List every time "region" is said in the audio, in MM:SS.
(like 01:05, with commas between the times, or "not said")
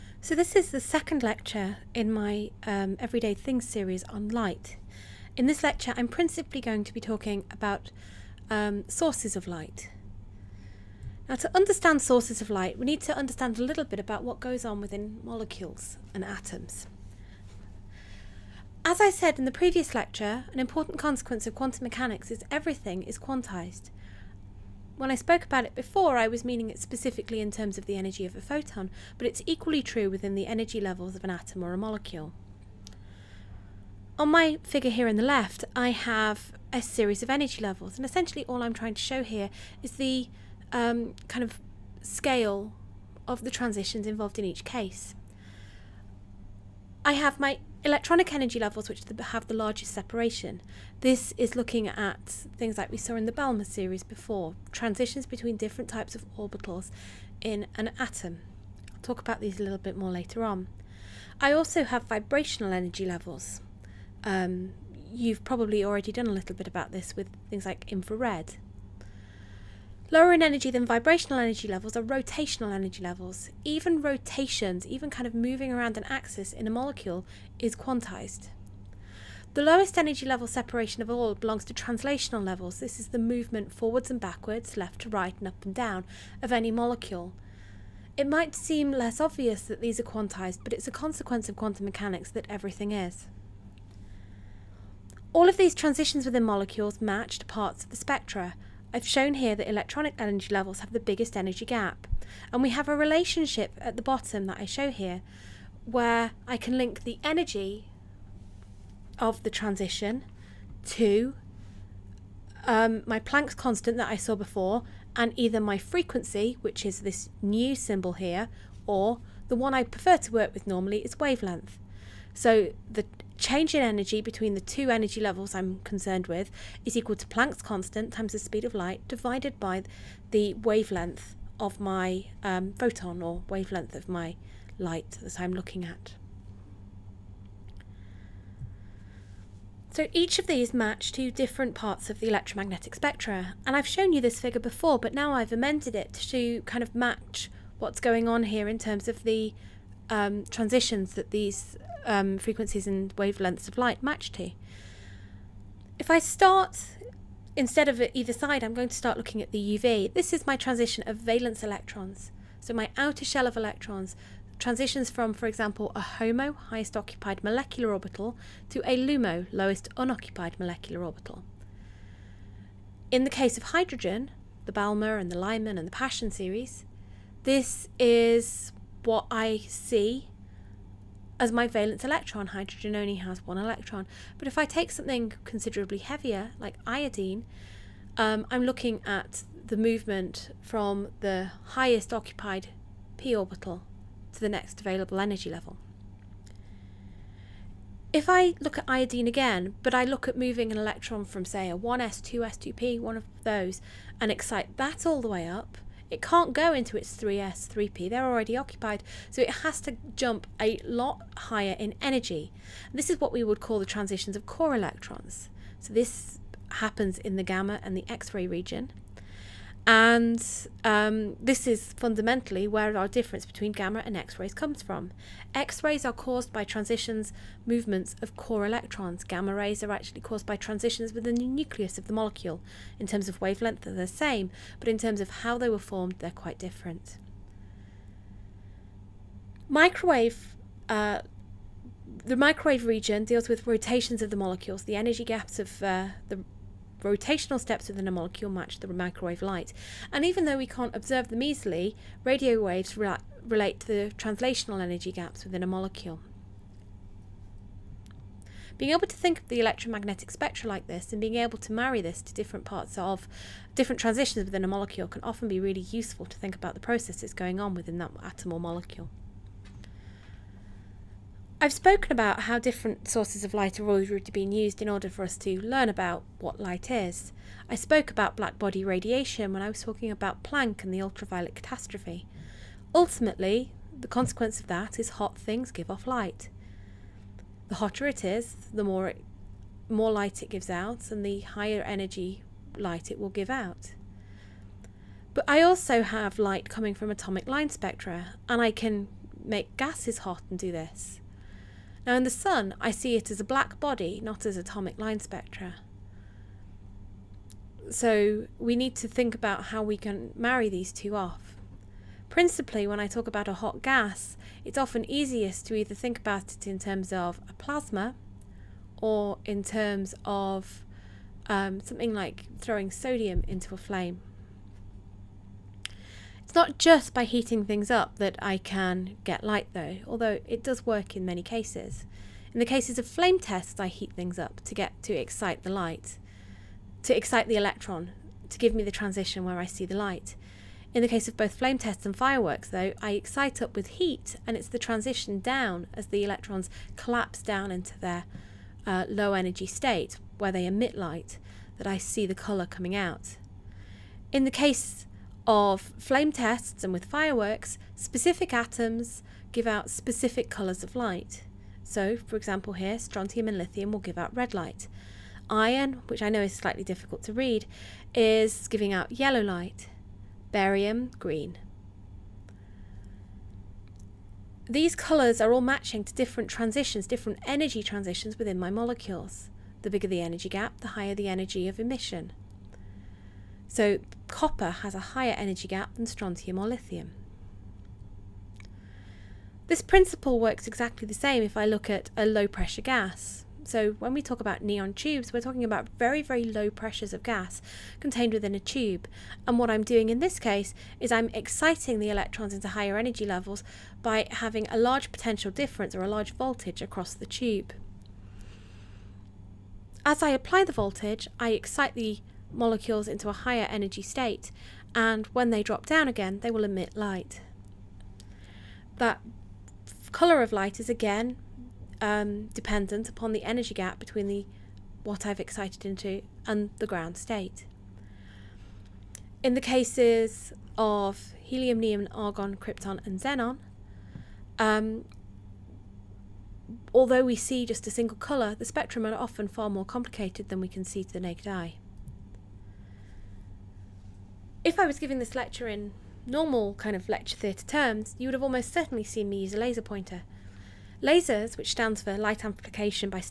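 03:38, 04:02.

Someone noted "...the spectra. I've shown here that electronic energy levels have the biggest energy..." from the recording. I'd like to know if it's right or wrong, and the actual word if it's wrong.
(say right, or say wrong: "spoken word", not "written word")
right.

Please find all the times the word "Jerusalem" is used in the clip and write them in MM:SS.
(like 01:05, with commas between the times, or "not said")
not said.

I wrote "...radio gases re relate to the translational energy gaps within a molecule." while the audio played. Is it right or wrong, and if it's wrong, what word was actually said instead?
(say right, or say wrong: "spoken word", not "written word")
wrong: "waves", not "gases".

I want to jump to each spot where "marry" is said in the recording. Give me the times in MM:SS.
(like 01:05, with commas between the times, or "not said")
04:21, 05:10.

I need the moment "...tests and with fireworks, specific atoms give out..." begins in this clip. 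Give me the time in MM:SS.
05:56.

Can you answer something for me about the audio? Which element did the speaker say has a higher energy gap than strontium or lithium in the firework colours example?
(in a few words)
copper.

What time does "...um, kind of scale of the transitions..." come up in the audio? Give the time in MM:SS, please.
00:40.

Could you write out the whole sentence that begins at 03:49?
Gamma rays are actually caused by transitions within the nucleus of the molecule.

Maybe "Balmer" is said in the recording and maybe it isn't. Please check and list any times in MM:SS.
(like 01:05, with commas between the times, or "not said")
00:53, 02:54.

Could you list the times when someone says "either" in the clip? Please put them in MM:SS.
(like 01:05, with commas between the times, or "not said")
01:55, 02:38, 05:15.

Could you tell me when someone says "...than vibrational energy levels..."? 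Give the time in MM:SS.
01:10.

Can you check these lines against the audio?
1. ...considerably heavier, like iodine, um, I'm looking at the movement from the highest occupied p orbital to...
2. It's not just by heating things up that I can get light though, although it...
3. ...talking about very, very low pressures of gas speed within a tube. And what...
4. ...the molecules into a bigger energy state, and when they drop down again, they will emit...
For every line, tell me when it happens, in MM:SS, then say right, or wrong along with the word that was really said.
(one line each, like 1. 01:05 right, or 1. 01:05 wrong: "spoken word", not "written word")
1. 03:05 right
2. 05:26 right
3. 06:35 wrong: "contained", not "speed"
4. 06:51 wrong: "higher", not "bigger".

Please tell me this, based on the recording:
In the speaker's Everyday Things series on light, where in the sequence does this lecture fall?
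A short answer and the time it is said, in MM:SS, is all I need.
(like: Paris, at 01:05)
second, at 00:00.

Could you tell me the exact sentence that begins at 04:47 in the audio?
The hotter it is, the more it, more light it gives out and the higher energy light it will give out.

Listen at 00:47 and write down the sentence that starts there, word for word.
I have my electronic energy levels which have the largest separation.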